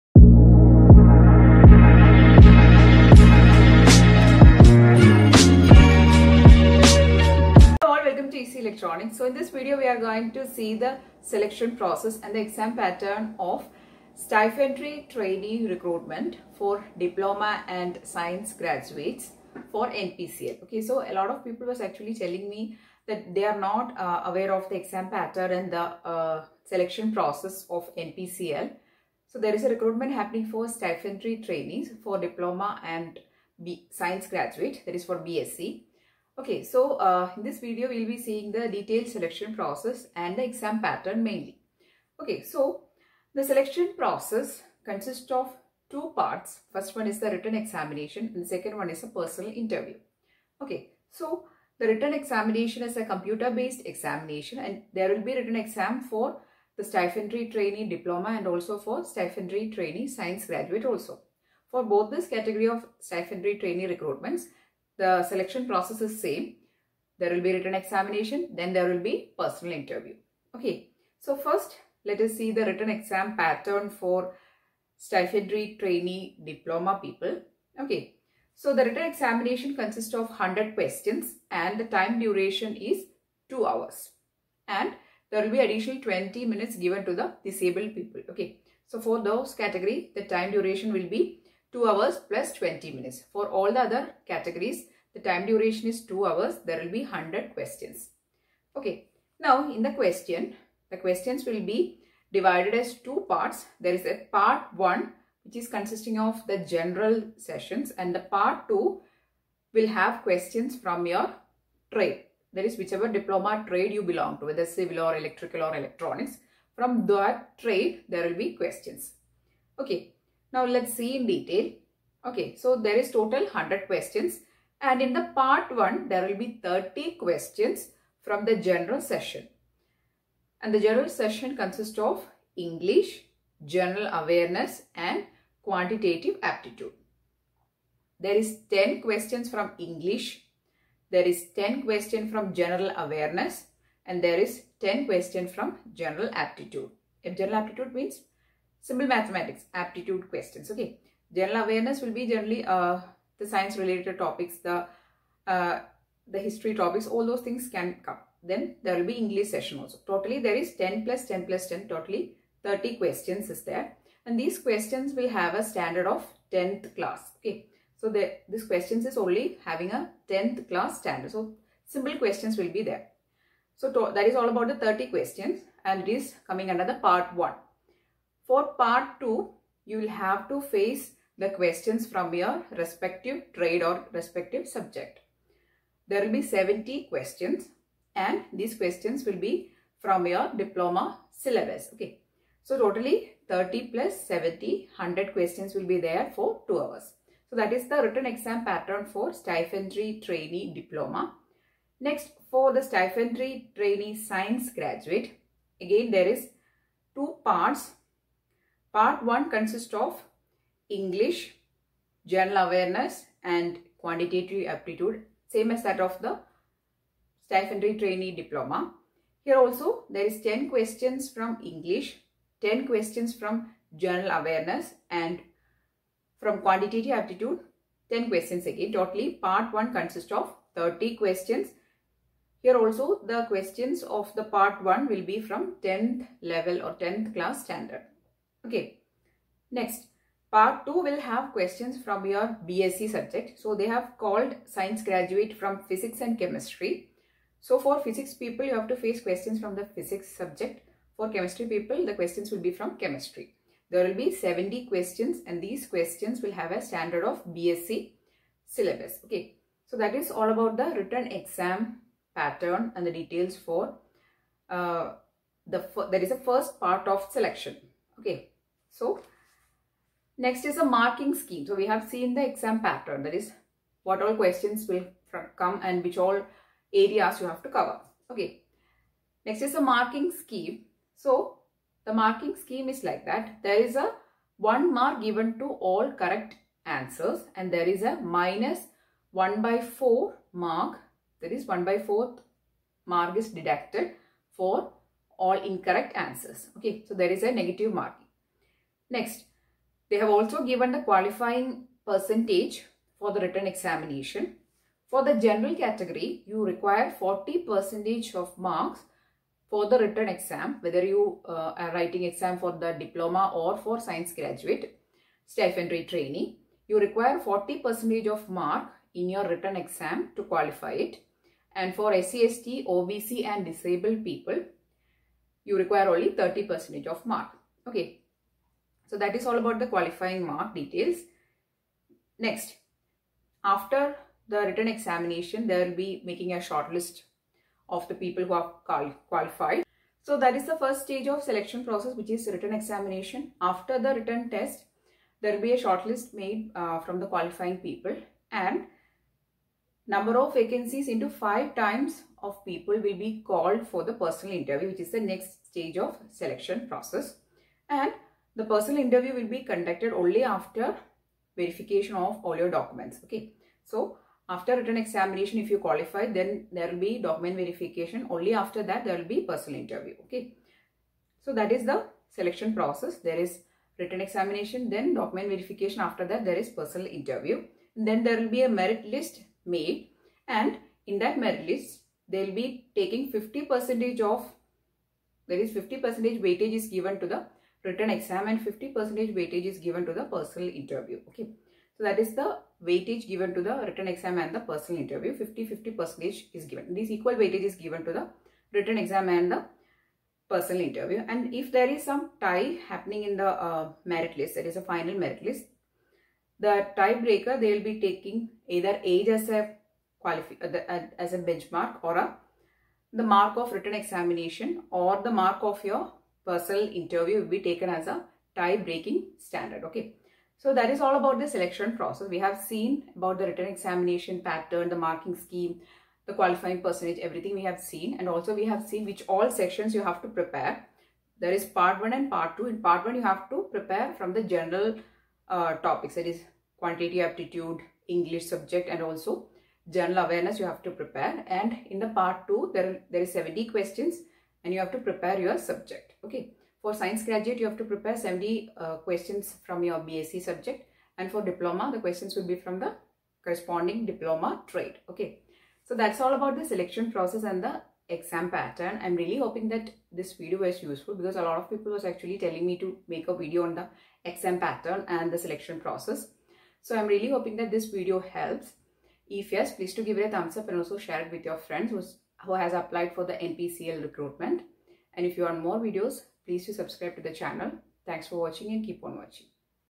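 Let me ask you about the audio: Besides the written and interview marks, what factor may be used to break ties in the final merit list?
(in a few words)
Age.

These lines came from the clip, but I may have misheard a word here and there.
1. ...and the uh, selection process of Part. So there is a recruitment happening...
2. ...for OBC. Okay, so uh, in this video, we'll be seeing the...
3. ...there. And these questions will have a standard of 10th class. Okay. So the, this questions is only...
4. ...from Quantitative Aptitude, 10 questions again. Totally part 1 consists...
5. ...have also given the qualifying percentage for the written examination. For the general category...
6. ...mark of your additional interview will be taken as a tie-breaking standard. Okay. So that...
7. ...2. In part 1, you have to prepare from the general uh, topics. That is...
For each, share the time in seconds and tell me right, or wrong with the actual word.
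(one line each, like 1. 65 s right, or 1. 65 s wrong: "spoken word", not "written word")
1. 25 s wrong: "NPCIL", not "Part"
2. 35 s wrong: "BSc", not "OBC"
3. 163 s right
4. 226 s right
5. 300 s right
6. 415 s wrong: "personal", not "additional"
7. 432 s right.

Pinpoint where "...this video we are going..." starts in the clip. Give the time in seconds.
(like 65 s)
9 s.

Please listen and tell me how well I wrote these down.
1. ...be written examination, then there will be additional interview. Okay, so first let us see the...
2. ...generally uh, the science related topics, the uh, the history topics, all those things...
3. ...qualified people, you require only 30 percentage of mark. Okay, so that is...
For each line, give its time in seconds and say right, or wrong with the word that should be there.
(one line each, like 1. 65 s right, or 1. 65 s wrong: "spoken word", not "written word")
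1. 67 s wrong: "personal", not "additional"
2. 152 s right
3. 323 s wrong: "disabled", not "qualified".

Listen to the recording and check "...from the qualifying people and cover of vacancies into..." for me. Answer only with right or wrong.
wrong.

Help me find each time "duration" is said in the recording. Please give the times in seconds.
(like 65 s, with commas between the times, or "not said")
82 s, 90 s, 95 s.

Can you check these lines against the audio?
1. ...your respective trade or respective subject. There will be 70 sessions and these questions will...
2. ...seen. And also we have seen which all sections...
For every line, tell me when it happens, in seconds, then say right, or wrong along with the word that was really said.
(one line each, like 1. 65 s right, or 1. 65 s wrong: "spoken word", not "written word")
1. 182 s wrong: "questions", not "sessions"
2. 427 s right.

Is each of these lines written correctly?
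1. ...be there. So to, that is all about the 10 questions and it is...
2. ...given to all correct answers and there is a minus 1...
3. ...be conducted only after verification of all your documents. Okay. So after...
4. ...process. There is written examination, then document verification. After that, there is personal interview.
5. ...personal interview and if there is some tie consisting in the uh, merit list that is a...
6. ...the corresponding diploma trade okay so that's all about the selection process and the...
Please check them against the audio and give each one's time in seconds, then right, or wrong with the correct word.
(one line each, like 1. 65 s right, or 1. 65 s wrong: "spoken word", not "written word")
1. 172 s wrong: "30", not "10"
2. 285 s right
3. 359 s right
4. 372 s right
5. 400 s wrong: "happening", not "consisting"
6. 452 s right.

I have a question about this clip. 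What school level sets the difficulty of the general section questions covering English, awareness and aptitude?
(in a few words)
10th class.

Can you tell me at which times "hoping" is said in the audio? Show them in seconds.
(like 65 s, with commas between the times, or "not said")
459 s, 467 s.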